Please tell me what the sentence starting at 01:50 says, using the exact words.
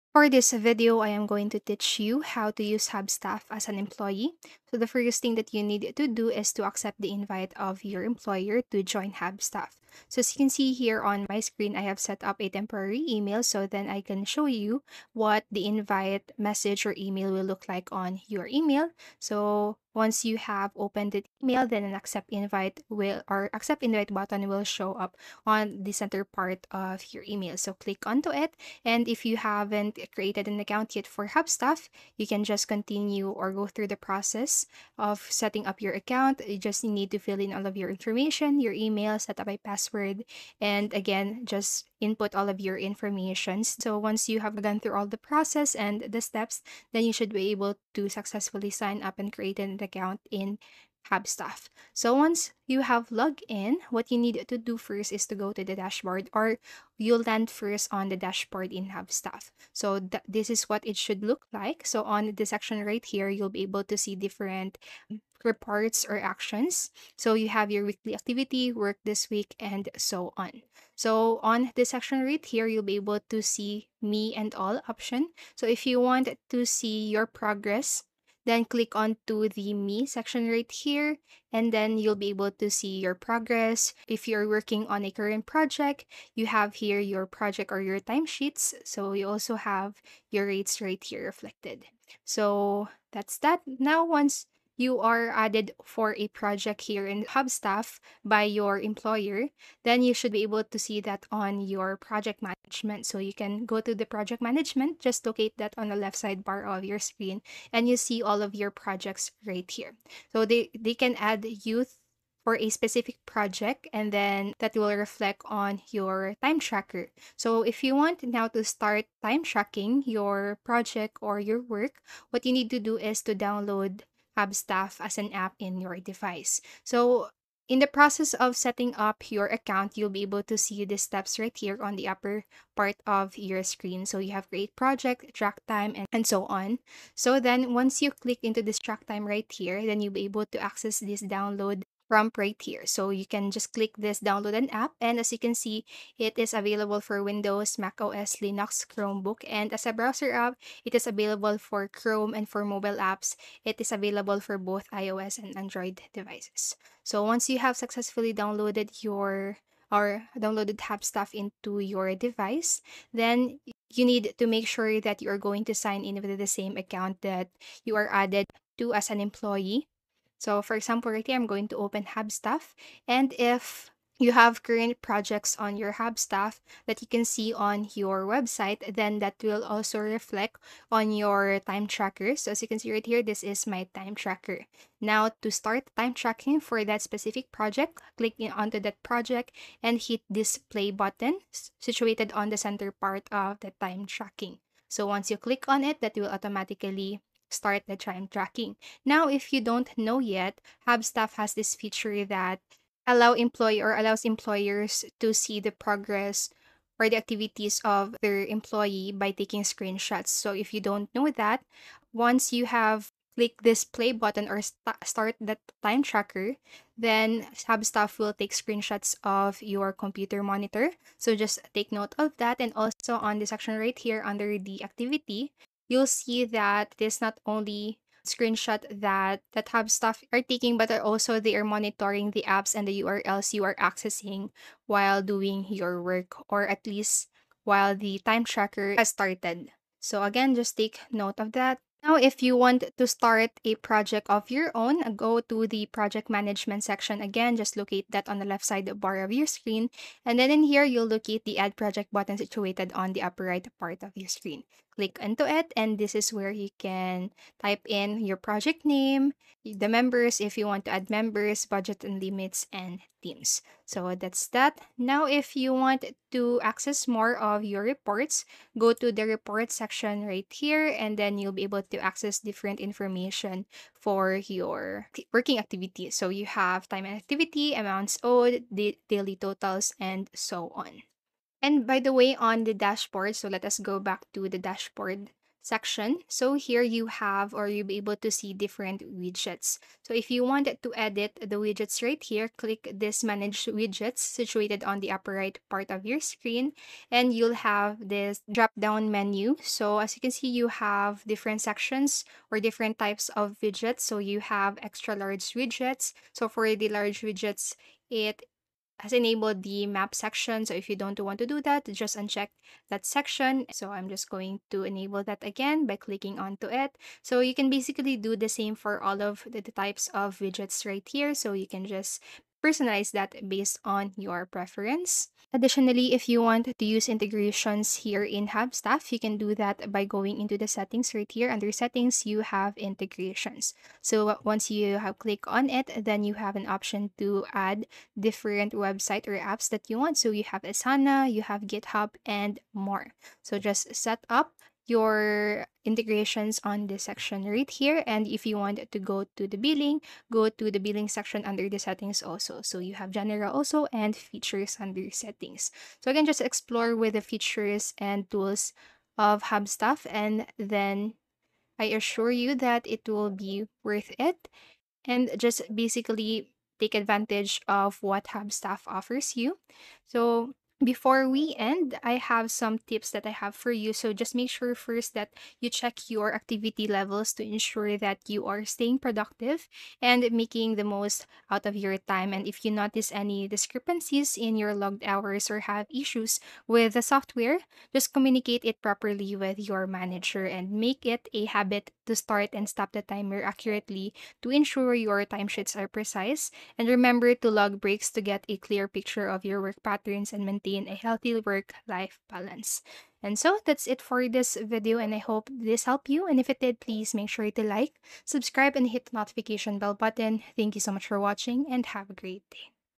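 So they, they can add youth for a specific project and then that will reflect on your time tracker.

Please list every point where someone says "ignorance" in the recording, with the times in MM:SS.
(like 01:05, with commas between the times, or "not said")
not said.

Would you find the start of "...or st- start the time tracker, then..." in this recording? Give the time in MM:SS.
03:34.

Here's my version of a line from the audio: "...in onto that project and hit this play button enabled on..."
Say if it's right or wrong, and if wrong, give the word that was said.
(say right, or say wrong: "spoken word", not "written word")
wrong: "situated", not "enabled".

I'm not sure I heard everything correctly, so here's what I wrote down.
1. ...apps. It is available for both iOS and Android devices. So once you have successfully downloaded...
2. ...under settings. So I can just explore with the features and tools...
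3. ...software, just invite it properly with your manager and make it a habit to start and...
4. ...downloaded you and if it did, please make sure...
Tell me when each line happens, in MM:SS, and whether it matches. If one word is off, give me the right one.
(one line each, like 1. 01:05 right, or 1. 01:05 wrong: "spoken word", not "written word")
1. 02:32 right
2. 05:54 right
3. 06:27 wrong: "communicate", not "invite"
4. 06:45 wrong: "helped", not "downloaded".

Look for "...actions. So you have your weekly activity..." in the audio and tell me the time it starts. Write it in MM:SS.
01:06.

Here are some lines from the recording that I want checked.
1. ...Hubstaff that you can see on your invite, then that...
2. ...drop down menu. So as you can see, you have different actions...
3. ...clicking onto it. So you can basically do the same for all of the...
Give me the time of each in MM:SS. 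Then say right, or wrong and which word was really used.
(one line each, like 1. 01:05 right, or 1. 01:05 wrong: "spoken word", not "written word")
1. 02:56 wrong: "website", not "invite"
2. 04:58 wrong: "sections", not "actions"
3. 05:15 right.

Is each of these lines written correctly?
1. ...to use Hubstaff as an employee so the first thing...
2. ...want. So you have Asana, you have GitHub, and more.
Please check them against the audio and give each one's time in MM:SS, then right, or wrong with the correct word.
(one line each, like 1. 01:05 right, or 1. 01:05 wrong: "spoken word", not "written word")
1. 00:02 right
2. 05:39 right.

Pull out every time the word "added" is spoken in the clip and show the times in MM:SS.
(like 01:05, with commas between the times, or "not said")
01:35, 02:48.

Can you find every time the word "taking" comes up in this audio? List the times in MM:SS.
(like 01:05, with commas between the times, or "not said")
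03:29, 03:50.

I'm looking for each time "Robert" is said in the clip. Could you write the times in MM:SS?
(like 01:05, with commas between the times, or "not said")
not said.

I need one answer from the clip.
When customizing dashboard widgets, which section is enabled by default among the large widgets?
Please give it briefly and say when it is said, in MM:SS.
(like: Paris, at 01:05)
Map, at 05:09.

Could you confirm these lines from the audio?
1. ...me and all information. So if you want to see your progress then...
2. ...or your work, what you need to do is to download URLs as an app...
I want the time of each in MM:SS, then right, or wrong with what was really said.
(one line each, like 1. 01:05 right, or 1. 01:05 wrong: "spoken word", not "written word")
1. 01:14 wrong: "option", not "information"
2. 02:01 wrong: "Staff", not "URLs".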